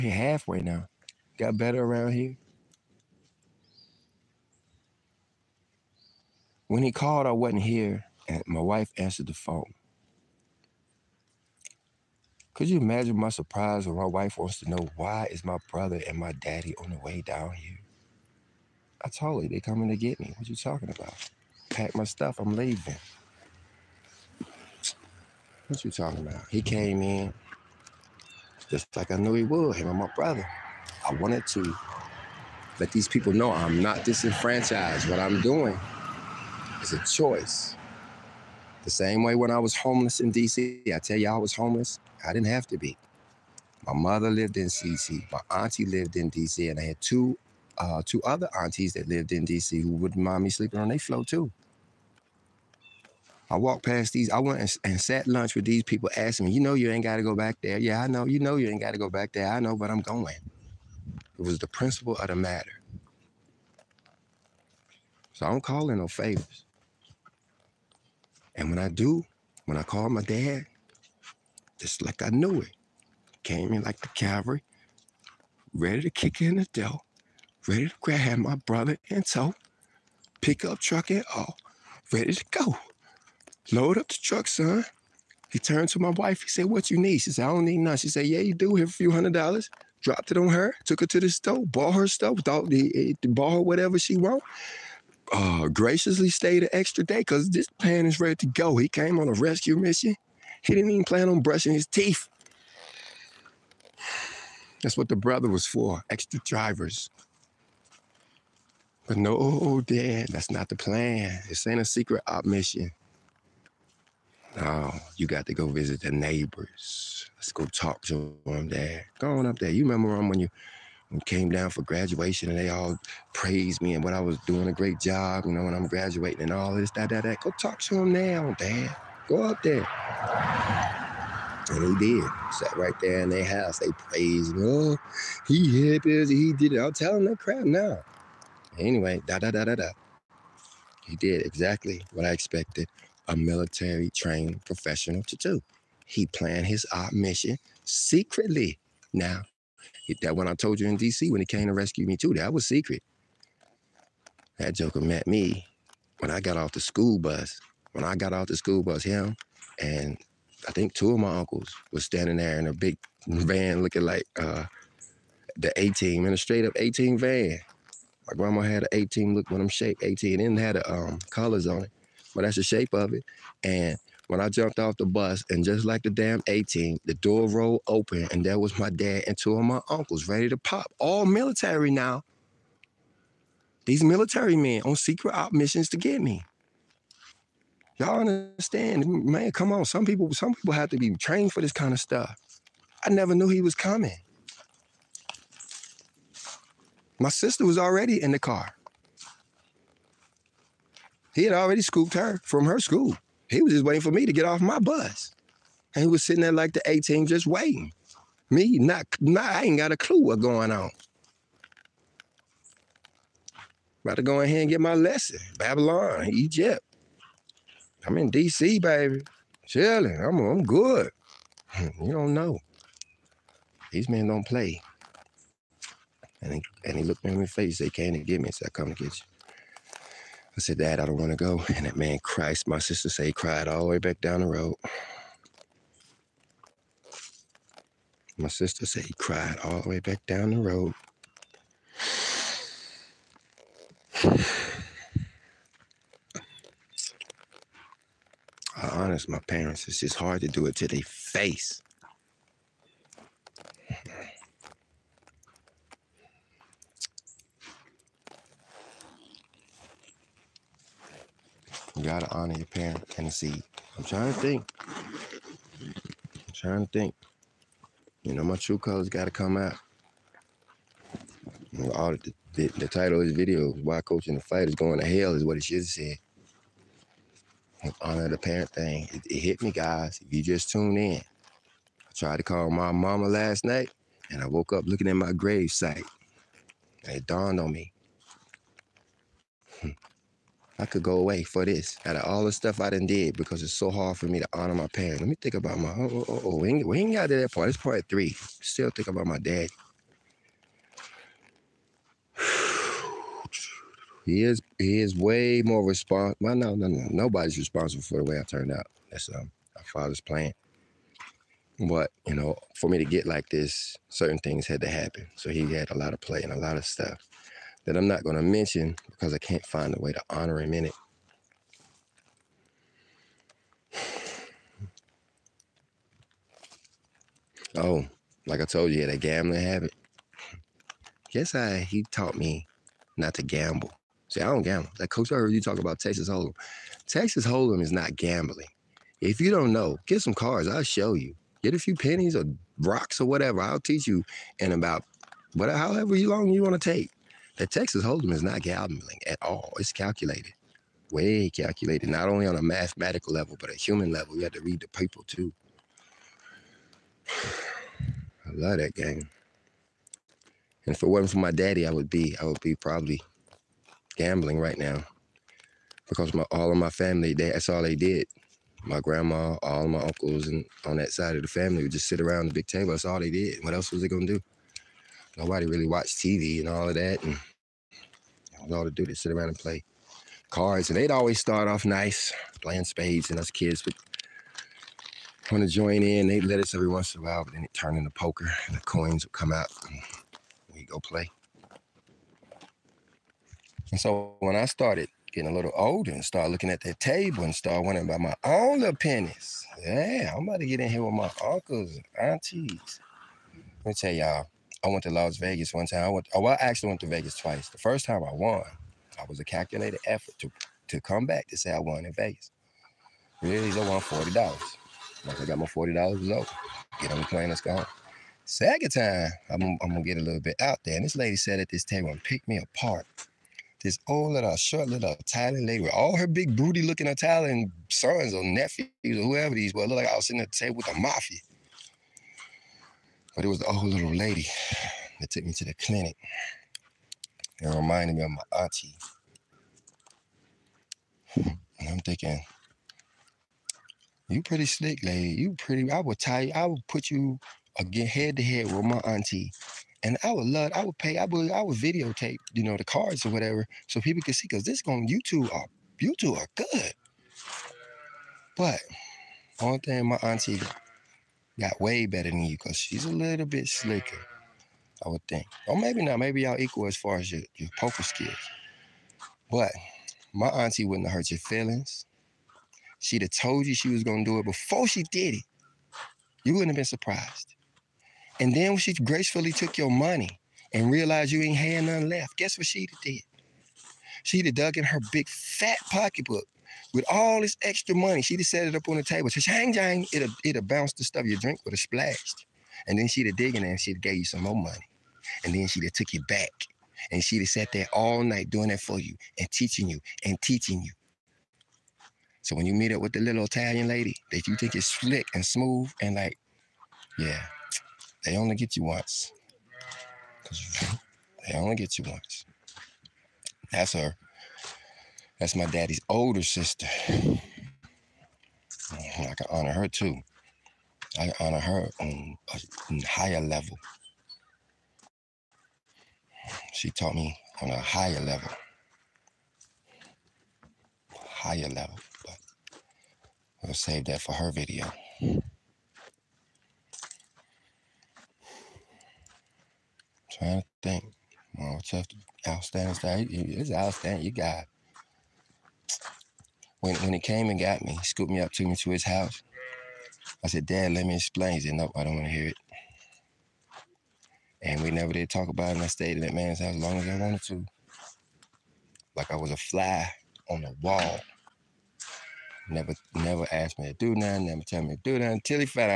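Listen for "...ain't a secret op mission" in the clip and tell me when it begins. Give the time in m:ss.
1:51.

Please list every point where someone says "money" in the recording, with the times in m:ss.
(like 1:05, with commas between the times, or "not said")
7:59, 8:07, 8:14.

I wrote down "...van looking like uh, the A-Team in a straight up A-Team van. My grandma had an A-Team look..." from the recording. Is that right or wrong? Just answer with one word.
right.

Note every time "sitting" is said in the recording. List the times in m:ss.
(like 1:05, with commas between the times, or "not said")
3:26, 7:10.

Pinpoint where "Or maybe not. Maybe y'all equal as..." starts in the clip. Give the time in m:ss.
7:45.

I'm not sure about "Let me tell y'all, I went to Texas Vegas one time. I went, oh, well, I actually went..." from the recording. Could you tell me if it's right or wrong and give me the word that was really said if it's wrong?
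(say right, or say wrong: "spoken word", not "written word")
wrong: "Las", not "Texas".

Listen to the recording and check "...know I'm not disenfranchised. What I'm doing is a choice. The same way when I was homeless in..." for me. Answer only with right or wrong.
right.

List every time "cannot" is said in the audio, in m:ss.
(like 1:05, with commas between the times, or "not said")
not said.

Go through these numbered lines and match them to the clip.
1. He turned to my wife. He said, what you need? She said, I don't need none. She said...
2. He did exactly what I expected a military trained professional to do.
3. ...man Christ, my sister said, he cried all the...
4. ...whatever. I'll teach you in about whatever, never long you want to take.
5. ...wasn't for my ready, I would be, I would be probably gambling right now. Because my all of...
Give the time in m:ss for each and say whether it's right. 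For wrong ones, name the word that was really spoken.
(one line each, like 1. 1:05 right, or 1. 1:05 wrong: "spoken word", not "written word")
1. 1:25 right
2. 2:21 right
3. 3:51 right
4. 5:43 wrong: "however", not "never"
5. 6:01 wrong: "daddy", not "ready".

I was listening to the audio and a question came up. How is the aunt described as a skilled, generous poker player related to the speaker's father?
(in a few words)
Older sister.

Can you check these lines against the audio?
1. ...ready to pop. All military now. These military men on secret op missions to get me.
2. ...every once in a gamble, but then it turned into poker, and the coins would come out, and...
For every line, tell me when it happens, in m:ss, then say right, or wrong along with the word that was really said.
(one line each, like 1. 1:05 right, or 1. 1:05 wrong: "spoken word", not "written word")
1. 3:00 right
2. 6:26 wrong: "while", not "gamble".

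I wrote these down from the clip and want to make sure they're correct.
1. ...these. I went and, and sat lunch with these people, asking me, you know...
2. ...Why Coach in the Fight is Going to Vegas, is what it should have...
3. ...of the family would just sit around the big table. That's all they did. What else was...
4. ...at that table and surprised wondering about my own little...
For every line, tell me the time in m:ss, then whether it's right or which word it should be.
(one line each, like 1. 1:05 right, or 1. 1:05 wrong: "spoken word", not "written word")
1. 0:54 right
2. 4:33 wrong: "Hell", not "Vegas"
3. 6:11 right
4. 6:36 wrong: "started", not "surprised".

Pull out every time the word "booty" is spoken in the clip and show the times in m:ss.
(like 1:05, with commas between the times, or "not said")
7:06.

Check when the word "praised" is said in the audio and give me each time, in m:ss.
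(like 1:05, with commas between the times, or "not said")
2:03, 2:13.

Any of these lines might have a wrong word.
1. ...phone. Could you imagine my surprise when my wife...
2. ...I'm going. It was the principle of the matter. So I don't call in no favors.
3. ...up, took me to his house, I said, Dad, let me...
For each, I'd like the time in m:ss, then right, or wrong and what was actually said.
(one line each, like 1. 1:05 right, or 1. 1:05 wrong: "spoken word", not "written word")
1. 0:09 right
2. 0:59 right
3. 9:08 right.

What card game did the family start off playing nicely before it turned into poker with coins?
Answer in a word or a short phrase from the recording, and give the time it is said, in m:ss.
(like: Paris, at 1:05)
Spades, at 6:22.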